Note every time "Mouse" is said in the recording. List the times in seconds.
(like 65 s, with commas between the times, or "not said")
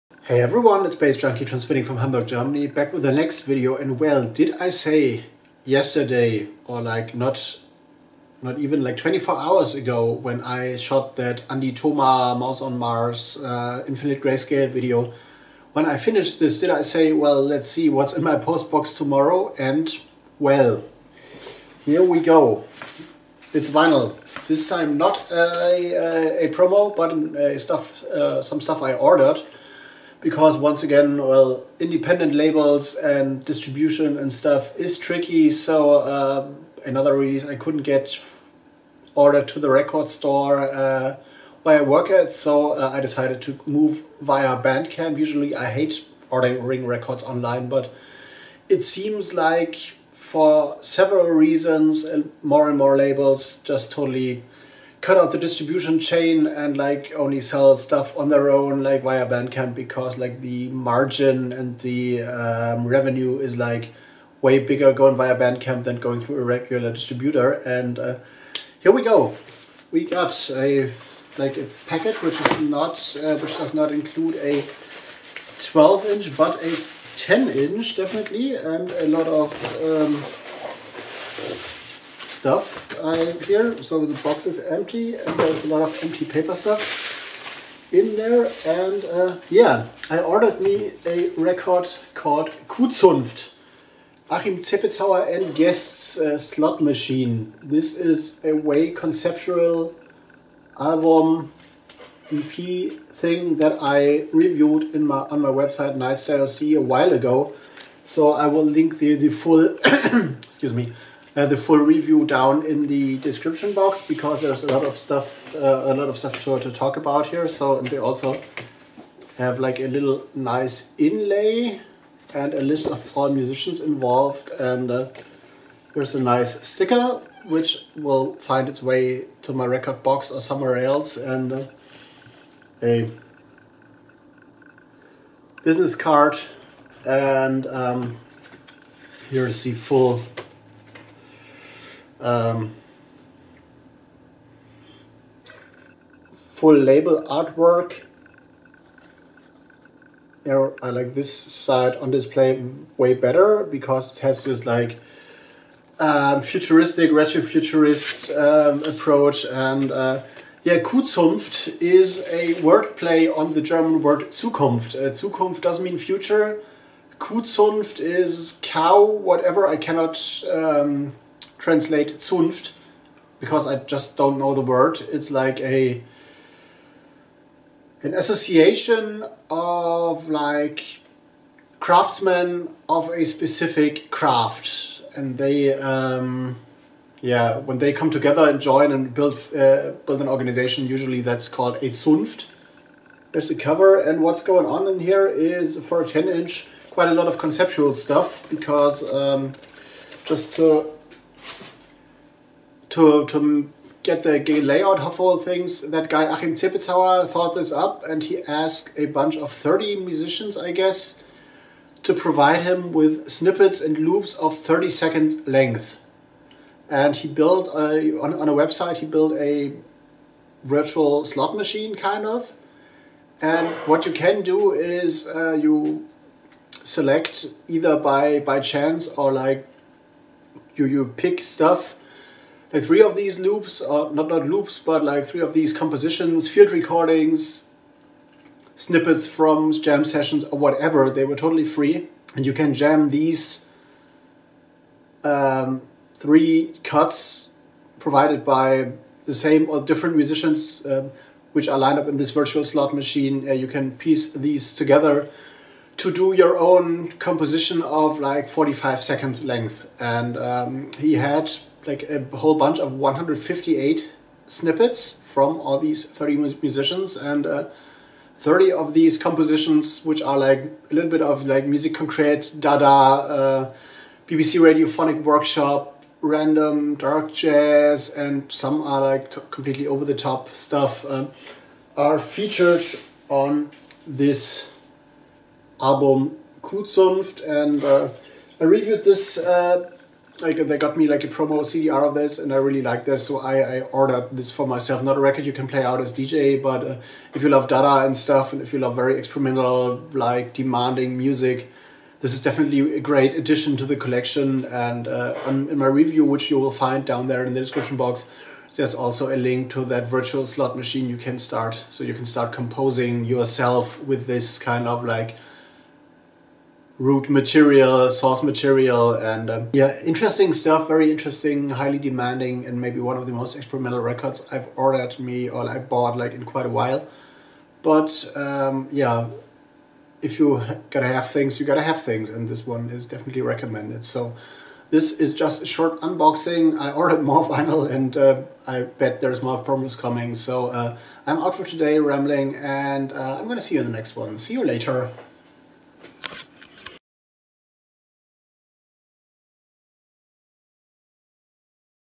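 12 s.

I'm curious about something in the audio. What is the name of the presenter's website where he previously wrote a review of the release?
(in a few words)
Nitestylez.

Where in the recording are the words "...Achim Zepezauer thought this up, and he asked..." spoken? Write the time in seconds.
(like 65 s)
206 s.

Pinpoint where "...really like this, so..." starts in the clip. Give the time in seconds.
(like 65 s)
292 s.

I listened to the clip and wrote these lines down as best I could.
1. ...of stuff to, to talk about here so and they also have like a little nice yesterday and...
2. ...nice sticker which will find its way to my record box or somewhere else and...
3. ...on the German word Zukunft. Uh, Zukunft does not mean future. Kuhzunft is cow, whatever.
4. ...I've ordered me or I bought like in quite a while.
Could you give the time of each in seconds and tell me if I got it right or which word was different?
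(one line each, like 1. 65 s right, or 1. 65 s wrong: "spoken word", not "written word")
1. 116 s wrong: "inlay", not "yesterday"
2. 126 s right
3. 163 s right
4. 324 s right.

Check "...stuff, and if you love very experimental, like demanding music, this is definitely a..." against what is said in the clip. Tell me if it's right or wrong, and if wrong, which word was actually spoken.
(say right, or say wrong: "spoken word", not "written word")
right.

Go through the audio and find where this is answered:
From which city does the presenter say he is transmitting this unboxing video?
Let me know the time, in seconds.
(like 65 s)
1 s.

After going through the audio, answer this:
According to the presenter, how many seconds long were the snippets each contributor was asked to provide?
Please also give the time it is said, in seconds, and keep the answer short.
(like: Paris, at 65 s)
30, at 214 s.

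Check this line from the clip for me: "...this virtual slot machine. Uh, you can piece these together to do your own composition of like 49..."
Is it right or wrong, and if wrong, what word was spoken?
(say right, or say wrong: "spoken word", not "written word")
wrong: "45", not "49".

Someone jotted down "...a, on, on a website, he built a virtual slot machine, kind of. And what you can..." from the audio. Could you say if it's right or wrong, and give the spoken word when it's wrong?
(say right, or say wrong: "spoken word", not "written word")
right.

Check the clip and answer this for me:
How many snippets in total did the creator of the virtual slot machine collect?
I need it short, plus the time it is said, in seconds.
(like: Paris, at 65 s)
158, at 262 s.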